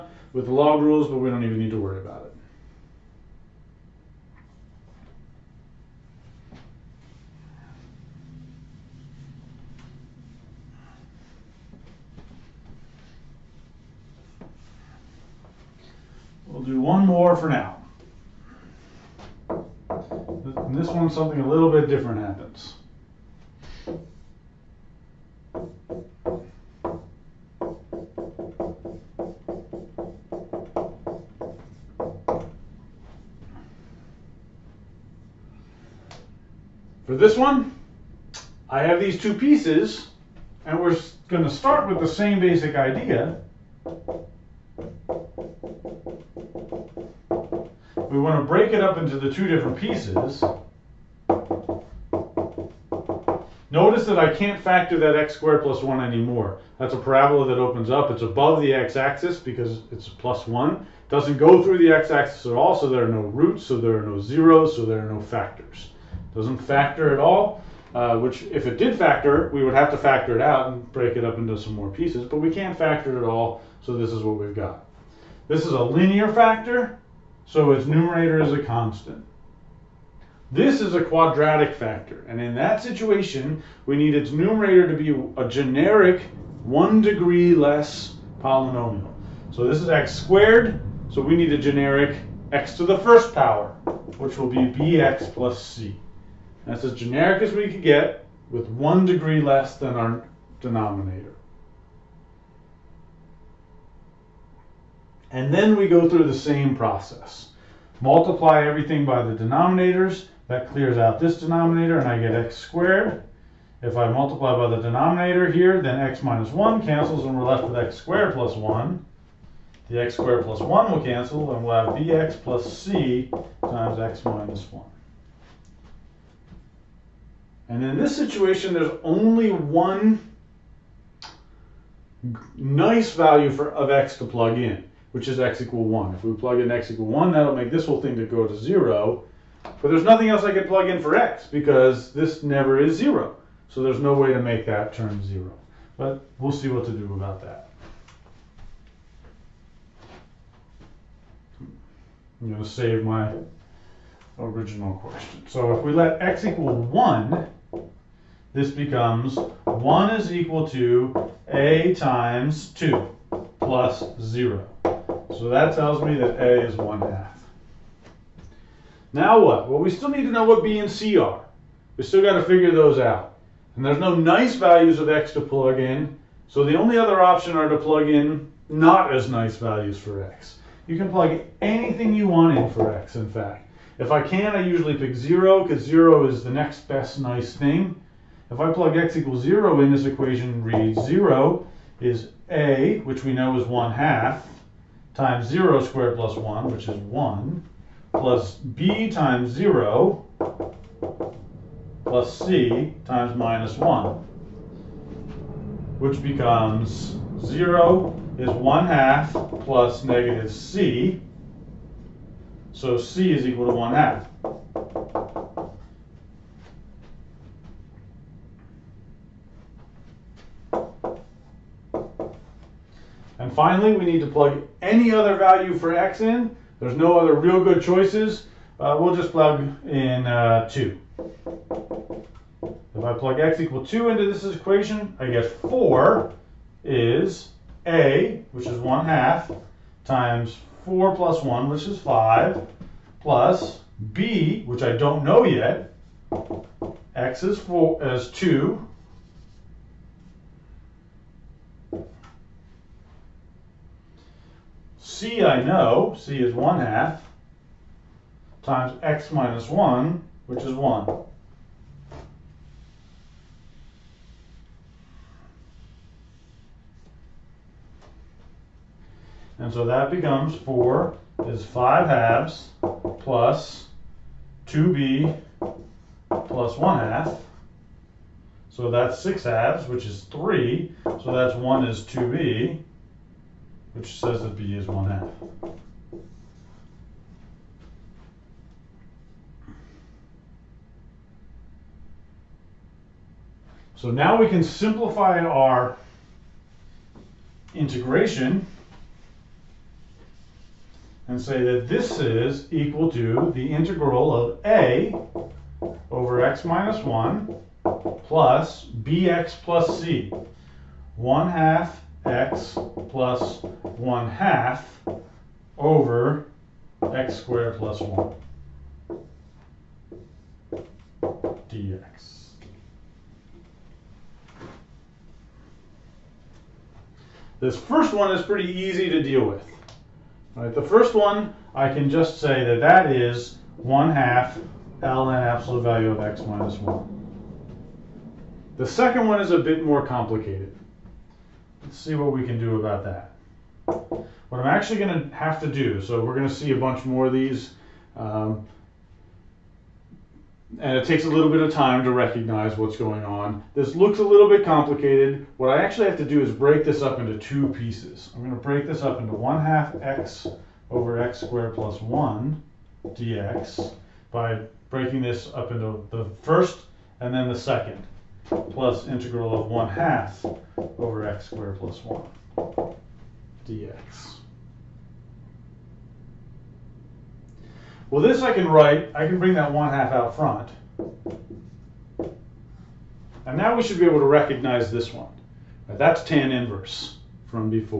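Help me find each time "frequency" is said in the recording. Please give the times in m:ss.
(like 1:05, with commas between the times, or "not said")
not said.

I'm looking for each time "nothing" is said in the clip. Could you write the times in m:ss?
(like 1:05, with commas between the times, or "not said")
2:20.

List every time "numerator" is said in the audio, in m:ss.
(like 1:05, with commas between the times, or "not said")
1:17, 1:24.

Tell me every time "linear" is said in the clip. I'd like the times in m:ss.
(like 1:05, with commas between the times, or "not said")
1:15.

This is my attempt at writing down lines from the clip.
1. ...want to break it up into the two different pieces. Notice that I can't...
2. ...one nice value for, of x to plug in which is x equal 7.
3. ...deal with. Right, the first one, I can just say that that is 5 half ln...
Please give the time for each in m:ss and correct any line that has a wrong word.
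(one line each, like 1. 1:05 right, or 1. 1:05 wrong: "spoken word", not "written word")
1. 0:48 right
2. 2:09 wrong: "1", not "7"
3. 5:29 wrong: "1", not "5".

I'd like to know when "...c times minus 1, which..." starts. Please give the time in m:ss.
3:22.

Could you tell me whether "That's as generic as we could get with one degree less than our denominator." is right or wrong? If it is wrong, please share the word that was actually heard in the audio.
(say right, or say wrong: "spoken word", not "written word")
right.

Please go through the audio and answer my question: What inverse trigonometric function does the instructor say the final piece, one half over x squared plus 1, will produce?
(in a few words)
tan inverse.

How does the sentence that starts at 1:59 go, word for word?
The x squared plus 1 will cancel, and we'll have bx plus c times x minus 1.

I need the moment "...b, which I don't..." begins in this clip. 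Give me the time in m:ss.
4:04.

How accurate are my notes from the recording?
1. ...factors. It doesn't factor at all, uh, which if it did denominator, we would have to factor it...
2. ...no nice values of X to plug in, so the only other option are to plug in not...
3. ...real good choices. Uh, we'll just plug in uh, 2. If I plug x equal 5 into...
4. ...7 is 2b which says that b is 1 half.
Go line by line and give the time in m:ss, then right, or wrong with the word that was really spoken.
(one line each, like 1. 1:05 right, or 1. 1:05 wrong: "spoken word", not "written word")
1. 1:05 wrong: "factor", not "denominator"
2. 2:53 right
3. 3:47 wrong: "2", not "5"
4. 4:41 wrong: "1", not "7".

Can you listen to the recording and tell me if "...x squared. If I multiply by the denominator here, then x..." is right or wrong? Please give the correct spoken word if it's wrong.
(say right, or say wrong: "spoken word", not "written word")
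right.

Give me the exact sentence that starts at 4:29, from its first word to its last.
And so that becomes 4 is 5 halves plus 2b plus 1 half.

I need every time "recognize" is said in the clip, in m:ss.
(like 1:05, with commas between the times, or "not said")
5:52, 6:24.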